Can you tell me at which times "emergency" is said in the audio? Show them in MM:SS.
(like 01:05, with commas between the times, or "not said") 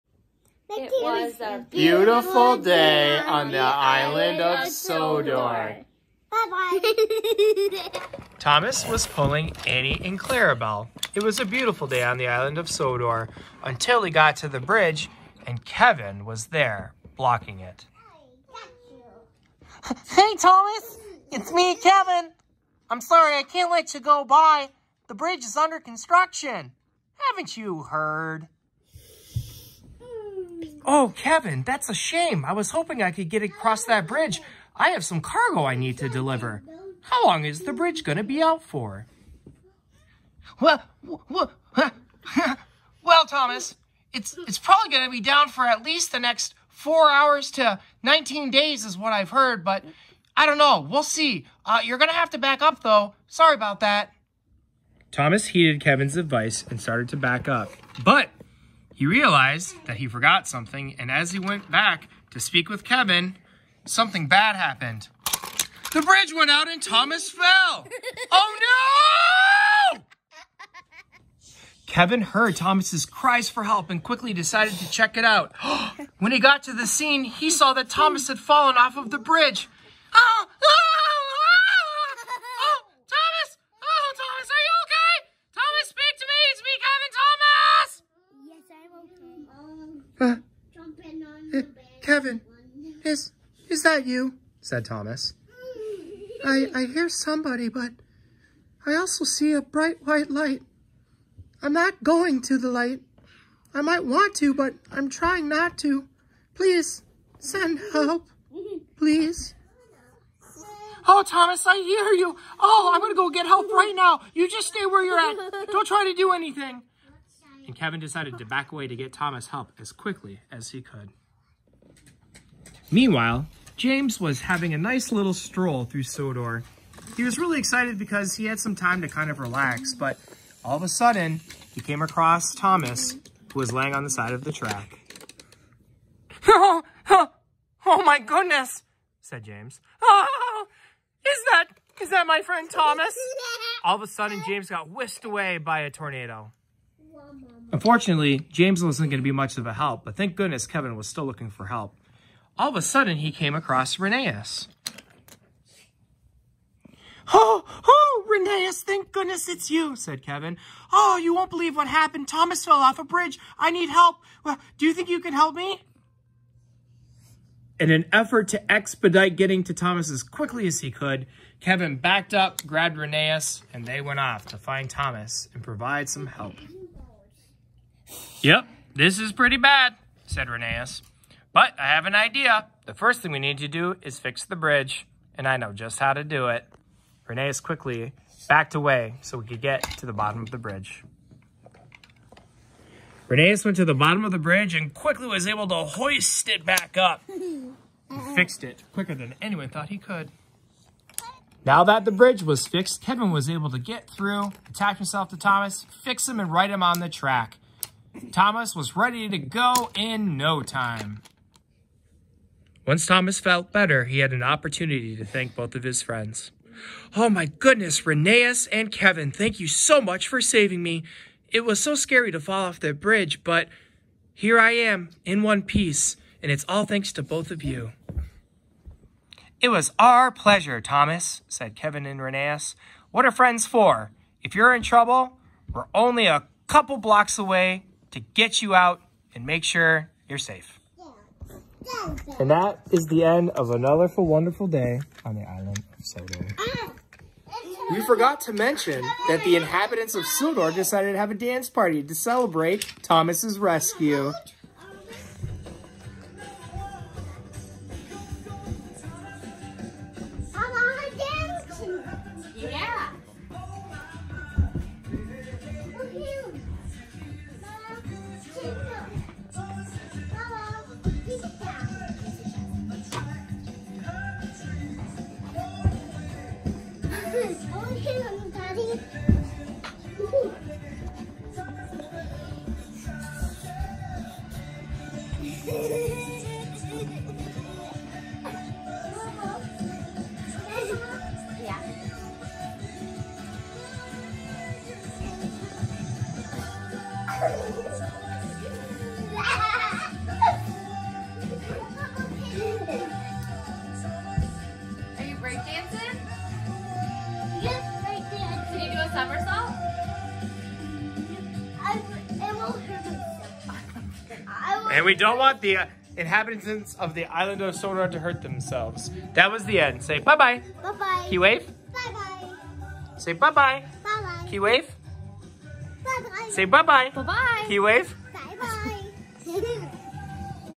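not said.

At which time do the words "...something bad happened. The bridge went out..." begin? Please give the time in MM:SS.
01:03.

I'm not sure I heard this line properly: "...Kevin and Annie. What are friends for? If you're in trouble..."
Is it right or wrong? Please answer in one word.
wrong.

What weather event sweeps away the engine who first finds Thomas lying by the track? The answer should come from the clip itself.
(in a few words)
A tornado.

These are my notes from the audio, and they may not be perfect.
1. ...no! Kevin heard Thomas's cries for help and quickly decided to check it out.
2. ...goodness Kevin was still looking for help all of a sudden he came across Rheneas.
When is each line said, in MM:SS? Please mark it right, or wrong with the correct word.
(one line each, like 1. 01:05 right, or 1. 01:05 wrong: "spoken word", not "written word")
1. 01:09 right
2. 02:30 right.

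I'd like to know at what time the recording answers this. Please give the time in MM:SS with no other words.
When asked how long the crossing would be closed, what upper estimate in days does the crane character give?
00:48.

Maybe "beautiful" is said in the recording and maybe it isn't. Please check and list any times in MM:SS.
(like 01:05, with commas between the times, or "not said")
00:01, 00:11.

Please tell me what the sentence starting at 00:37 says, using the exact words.
How long is the bridge going to be out for?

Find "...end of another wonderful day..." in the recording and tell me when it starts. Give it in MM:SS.
04:03.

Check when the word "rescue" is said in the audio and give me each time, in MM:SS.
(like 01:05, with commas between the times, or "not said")
04:13.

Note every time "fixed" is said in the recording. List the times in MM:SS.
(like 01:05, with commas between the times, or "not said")
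03:18, 03:22.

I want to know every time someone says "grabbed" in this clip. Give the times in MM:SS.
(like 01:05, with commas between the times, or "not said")
02:52.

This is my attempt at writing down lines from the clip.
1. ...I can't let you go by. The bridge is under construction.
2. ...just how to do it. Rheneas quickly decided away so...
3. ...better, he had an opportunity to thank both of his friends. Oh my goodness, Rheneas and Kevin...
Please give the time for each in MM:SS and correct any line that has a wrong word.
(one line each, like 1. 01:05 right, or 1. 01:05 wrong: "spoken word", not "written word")
1. 00:23 right
2. 03:05 wrong: "backed", not "decided"
3. 03:33 right.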